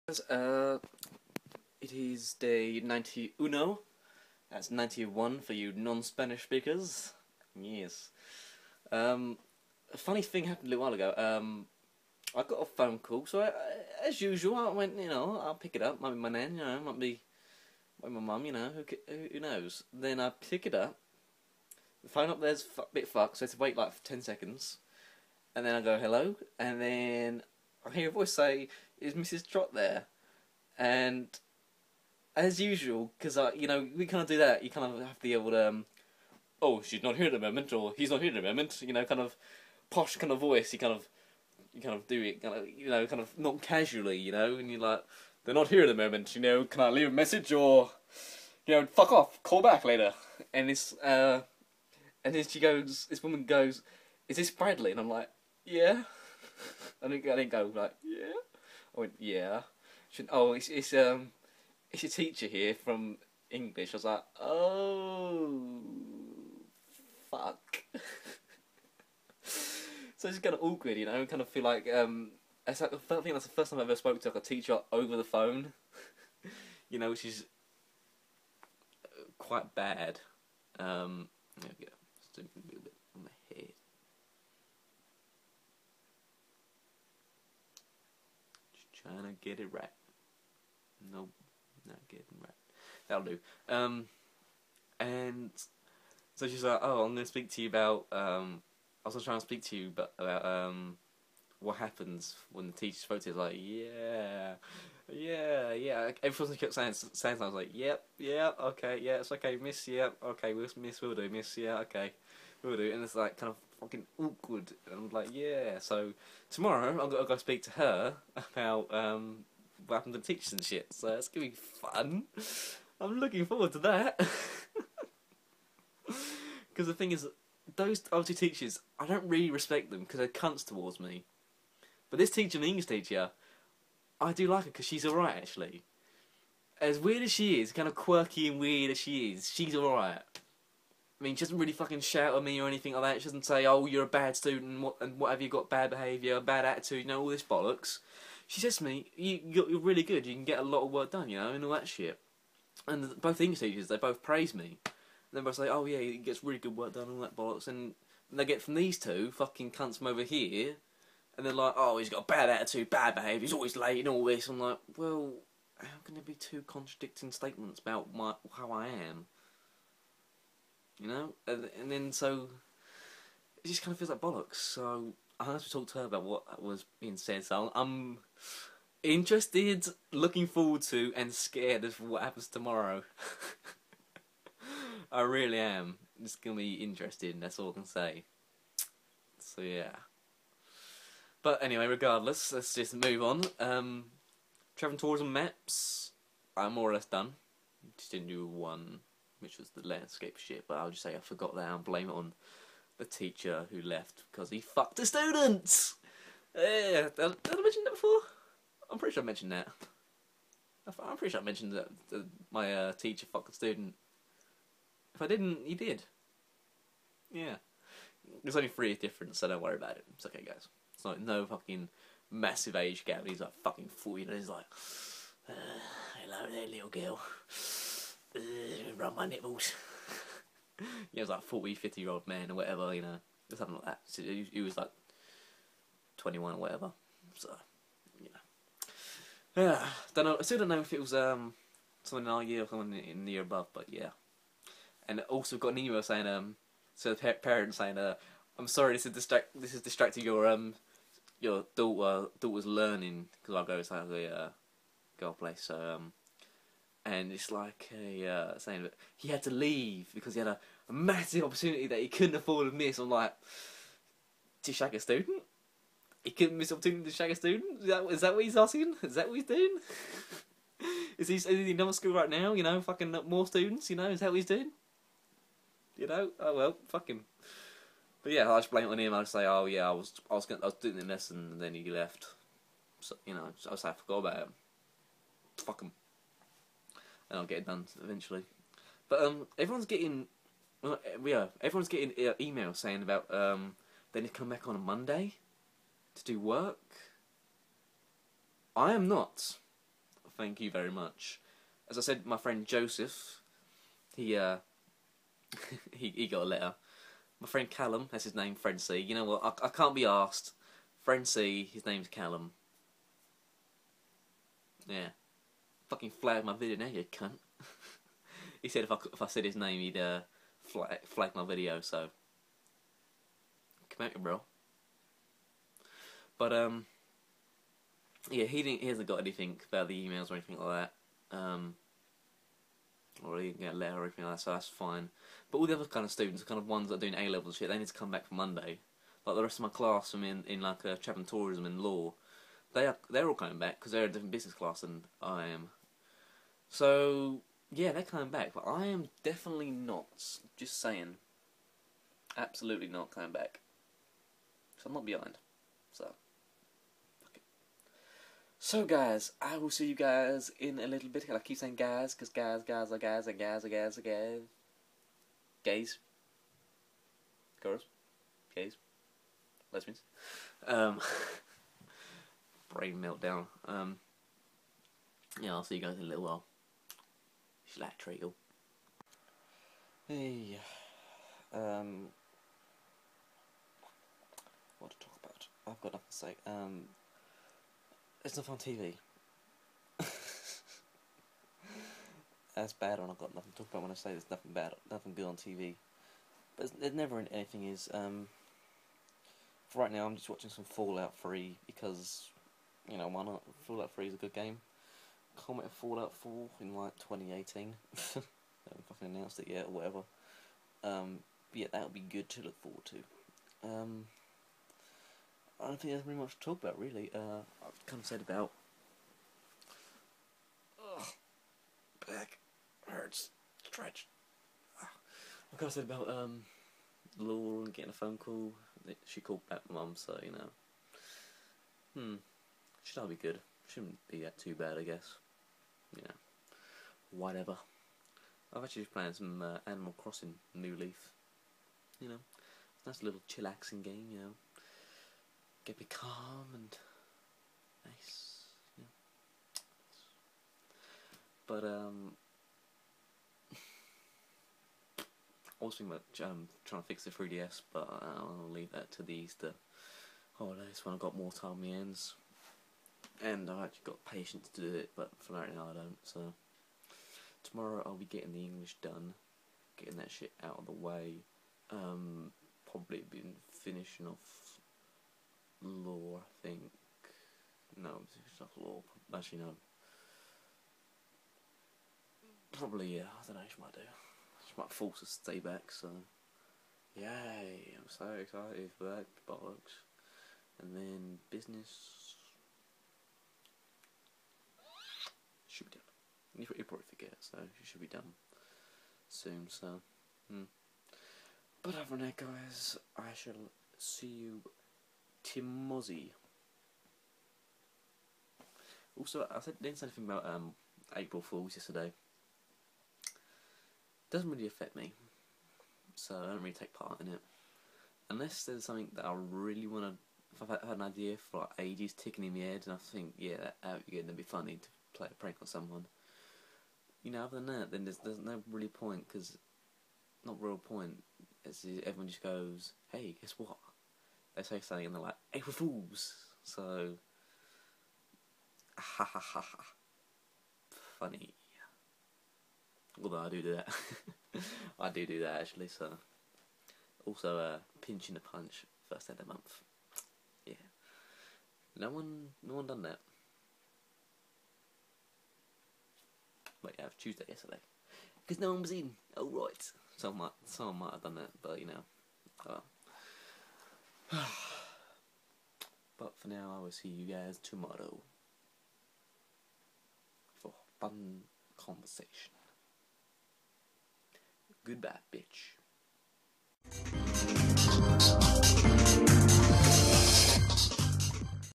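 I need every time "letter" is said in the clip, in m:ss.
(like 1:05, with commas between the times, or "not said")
5:06, 5:33.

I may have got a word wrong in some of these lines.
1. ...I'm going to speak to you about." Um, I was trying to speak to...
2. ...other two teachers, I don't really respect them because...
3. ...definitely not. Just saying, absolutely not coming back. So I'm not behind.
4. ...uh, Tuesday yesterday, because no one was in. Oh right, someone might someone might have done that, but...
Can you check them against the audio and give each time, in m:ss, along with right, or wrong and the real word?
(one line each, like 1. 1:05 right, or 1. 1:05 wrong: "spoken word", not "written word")
1. 1:37 right
2. 2:08 right
3. 5:49 right
4. 9:16 right.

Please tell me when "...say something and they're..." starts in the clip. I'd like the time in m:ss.
8:54.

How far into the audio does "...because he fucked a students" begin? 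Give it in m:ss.
3:24.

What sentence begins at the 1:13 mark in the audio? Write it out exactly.
That's the first time I ever spoke to like a teacher over the phone.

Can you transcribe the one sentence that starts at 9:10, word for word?
Yeah, no one, no one done that.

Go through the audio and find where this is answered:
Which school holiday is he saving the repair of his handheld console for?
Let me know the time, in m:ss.
7:39.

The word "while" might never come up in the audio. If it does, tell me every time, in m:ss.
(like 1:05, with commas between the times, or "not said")
0:10, 6:16.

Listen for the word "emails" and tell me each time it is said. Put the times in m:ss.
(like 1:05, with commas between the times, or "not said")
4:05, 4:52, 5:30.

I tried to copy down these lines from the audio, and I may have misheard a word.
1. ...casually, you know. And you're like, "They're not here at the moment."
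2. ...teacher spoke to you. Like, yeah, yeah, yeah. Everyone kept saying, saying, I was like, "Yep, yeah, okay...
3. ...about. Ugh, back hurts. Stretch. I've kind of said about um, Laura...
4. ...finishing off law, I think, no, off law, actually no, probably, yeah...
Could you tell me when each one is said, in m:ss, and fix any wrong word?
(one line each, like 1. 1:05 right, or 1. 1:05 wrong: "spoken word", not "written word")
1. 0:43 right
2. 1:42 right
3. 6:58 right
4. 7:53 right.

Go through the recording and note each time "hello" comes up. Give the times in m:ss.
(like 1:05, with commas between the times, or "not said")
0:25, 3:46.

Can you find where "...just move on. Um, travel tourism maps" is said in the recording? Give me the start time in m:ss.
3:12.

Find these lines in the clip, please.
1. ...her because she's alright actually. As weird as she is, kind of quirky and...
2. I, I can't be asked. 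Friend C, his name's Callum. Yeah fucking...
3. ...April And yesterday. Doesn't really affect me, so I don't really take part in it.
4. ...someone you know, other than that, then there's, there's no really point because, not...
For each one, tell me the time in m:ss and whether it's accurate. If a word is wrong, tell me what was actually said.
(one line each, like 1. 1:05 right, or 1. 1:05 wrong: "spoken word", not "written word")
1. 2:14 right
2. 5:09 right
3. 8:30 wrong: "Fools", not "And"
4. 8:45 right.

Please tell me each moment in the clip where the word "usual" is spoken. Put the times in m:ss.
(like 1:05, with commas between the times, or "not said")
0:14, 0:32.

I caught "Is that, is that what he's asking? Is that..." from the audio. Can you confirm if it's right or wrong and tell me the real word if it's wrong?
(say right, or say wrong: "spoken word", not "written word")
right.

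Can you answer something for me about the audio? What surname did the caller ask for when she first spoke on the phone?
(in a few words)
Trot.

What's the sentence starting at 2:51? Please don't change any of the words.
And, and then so it just kind of feels like bollocks.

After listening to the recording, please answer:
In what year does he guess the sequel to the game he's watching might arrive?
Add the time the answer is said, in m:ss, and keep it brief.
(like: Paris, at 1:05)
2018, at 6:46.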